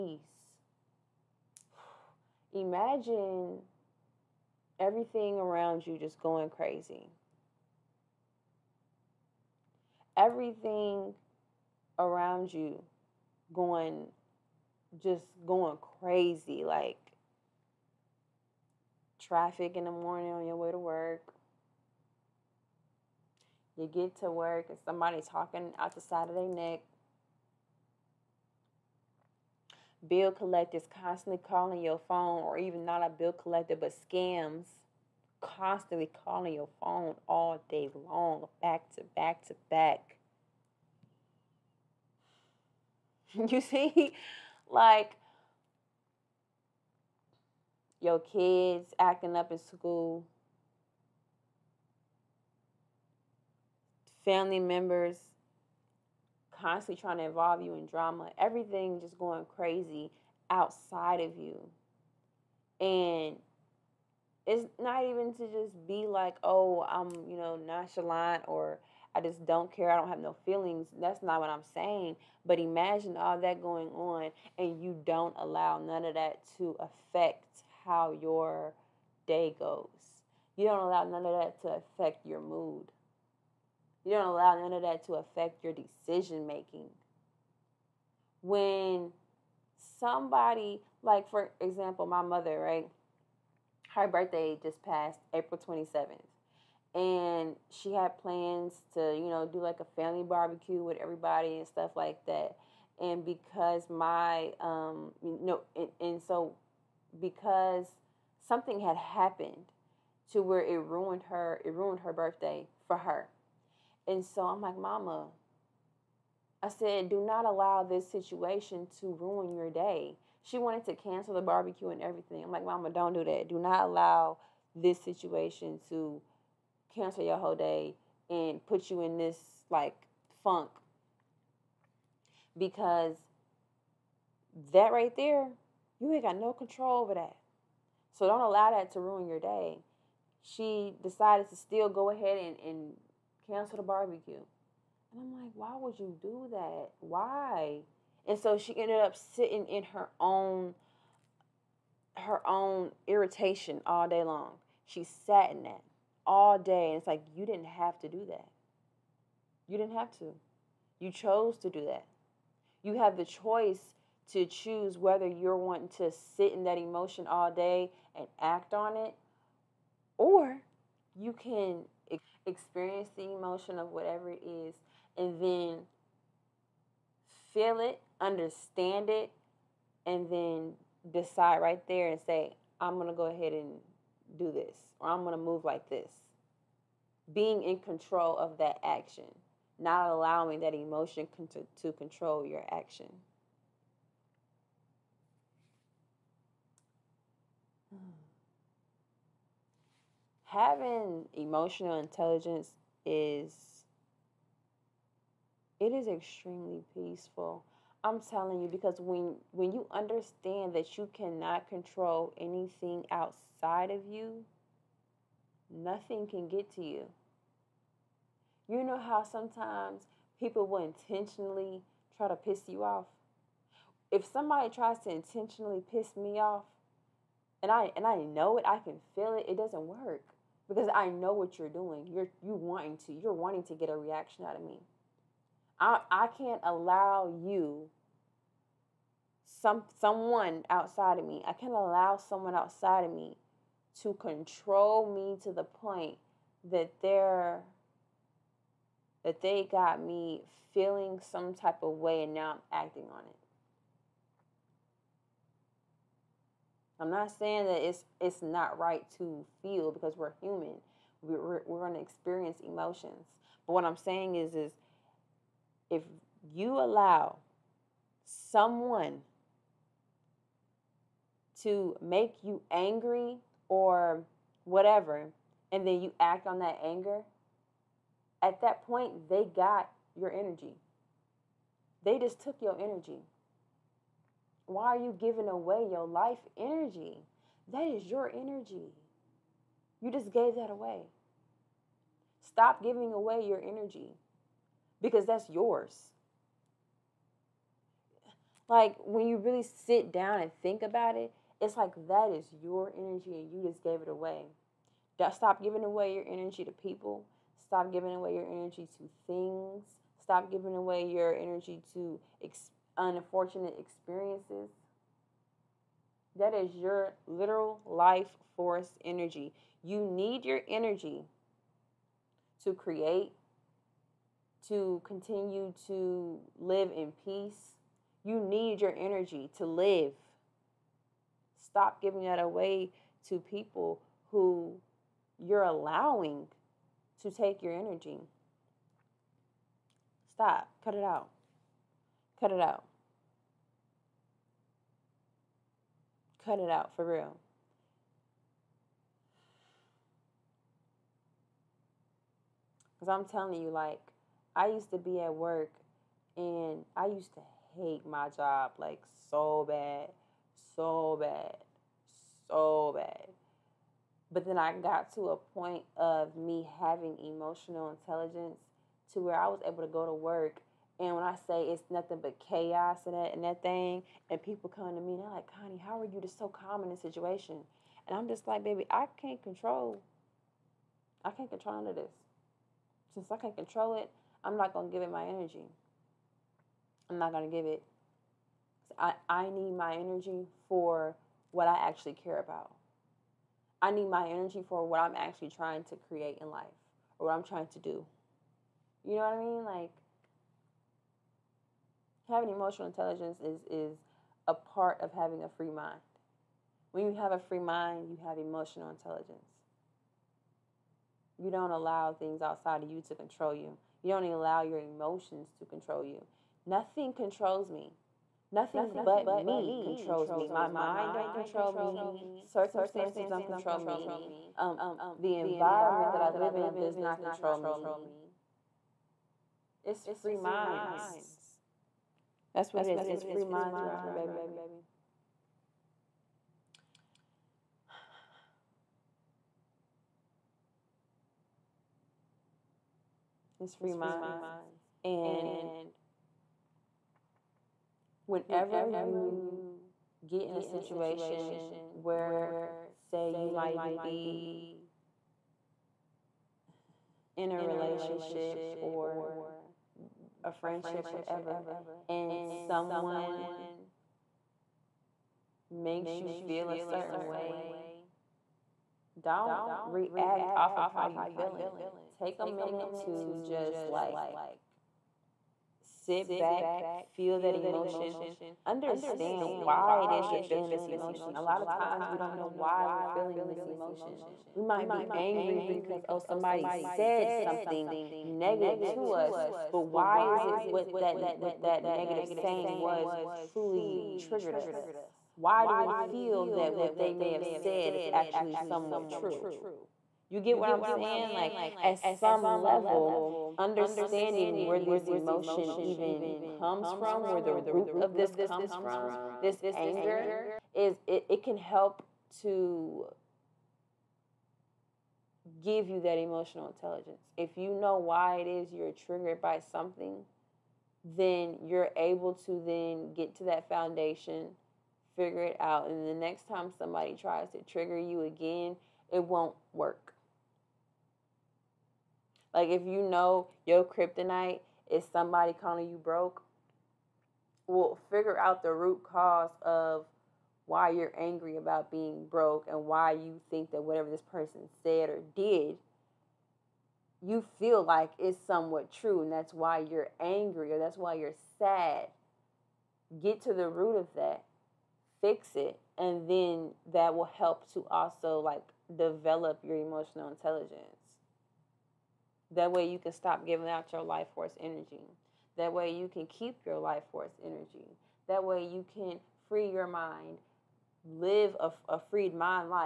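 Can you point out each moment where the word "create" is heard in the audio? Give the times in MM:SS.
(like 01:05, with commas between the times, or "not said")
05:22, 06:36.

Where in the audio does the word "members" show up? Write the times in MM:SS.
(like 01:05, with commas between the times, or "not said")
00:54.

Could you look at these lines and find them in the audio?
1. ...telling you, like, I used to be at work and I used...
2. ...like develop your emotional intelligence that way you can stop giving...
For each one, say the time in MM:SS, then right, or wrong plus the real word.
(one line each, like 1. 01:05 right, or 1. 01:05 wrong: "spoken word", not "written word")
1. 05:53 right
2. 09:18 right.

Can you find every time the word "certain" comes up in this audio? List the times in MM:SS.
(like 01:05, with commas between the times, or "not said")
07:46.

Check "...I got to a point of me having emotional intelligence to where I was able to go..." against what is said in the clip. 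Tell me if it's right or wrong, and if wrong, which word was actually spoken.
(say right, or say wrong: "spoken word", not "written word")
right.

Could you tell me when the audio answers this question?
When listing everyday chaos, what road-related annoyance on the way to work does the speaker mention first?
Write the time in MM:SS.
00:19.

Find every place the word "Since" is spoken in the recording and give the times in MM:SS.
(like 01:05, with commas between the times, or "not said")
06:23.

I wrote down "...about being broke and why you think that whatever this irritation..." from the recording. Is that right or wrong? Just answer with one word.
wrong.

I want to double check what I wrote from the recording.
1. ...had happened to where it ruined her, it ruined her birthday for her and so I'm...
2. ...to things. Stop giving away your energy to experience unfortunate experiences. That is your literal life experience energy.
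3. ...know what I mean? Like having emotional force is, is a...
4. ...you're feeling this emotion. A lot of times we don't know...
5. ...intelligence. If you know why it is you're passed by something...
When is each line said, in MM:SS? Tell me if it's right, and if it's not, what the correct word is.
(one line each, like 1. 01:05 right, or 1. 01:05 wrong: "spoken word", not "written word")
1. 01:48 right
2. 05:08 wrong: "force", not "experience"
3. 06:39 wrong: "intelligence", not "force"
4. 08:00 right
5. 08:36 wrong: "triggered", not "passed".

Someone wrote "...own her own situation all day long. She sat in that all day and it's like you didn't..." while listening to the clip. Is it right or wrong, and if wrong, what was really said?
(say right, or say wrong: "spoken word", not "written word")
wrong: "irritation", not "situation".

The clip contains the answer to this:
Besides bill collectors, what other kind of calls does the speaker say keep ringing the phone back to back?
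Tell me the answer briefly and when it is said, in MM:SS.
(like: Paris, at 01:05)
scams, at 00:34.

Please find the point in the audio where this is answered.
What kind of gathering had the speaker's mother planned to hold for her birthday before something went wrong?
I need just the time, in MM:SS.
01:40.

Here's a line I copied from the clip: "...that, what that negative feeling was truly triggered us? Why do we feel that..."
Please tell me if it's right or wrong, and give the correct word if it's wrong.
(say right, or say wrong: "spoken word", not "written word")
wrong: "saying", not "feeling".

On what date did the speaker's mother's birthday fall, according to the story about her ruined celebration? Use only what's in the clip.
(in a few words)
April 27.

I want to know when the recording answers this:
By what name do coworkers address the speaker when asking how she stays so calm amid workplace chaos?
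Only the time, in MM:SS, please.
06:15.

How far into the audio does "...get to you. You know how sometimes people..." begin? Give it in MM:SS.
03:36.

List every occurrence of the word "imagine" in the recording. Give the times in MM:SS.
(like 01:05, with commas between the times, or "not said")
00:02, 01:12.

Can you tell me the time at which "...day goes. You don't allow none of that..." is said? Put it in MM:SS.
01:19.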